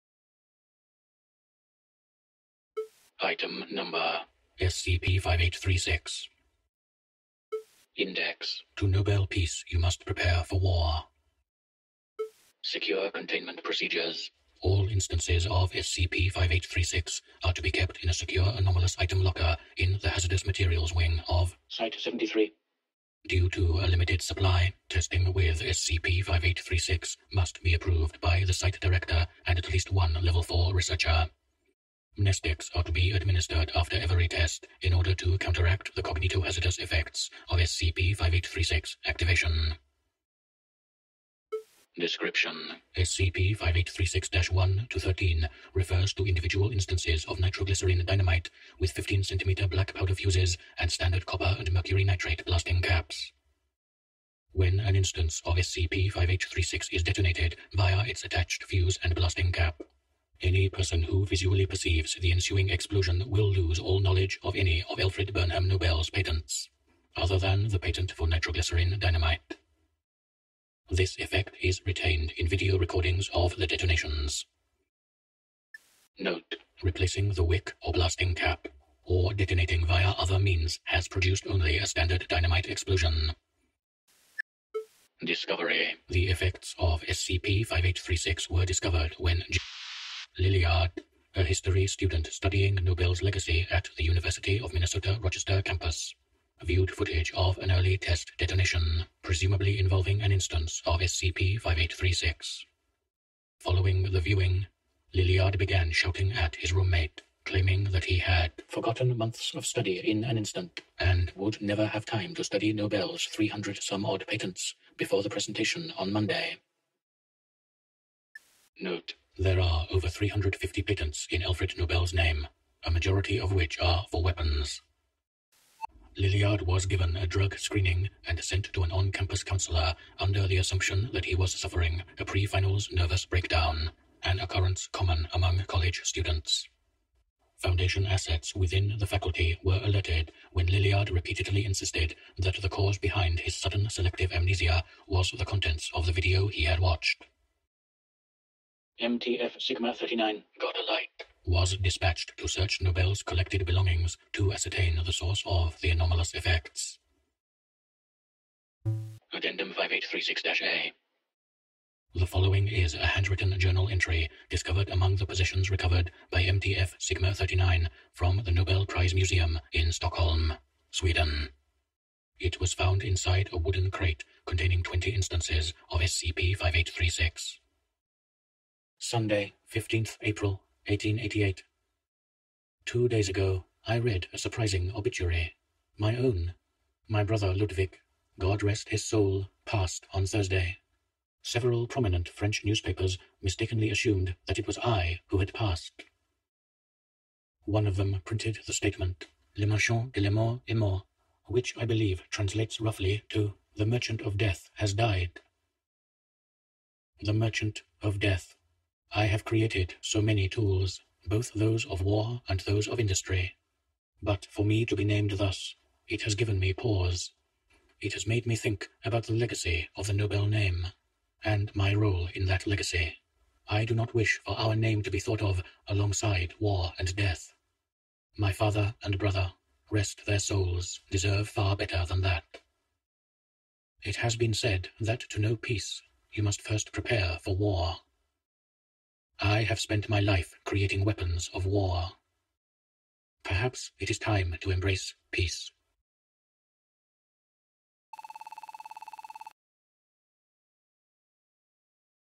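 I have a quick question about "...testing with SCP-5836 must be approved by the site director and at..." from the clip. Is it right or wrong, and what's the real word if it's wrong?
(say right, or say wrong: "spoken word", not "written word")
right.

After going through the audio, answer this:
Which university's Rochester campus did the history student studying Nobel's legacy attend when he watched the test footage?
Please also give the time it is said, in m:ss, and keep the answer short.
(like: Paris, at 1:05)
University of Minnesota, at 1:34.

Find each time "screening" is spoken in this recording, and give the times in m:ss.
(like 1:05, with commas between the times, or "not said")
2:07.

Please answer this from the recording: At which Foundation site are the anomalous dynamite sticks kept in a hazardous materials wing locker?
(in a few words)
Site-73.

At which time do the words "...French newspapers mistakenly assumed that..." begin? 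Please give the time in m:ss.
3:12.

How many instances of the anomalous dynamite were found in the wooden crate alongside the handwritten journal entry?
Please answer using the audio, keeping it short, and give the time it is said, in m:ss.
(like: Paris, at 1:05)
20, at 2:54.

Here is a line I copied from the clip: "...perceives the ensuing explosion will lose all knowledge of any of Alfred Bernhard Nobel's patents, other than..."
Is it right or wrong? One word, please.
right.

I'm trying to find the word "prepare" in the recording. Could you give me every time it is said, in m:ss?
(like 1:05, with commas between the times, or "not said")
0:10, 3:56.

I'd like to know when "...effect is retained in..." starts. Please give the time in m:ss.
1:11.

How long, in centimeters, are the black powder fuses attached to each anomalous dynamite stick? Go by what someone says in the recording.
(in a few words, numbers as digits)
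15.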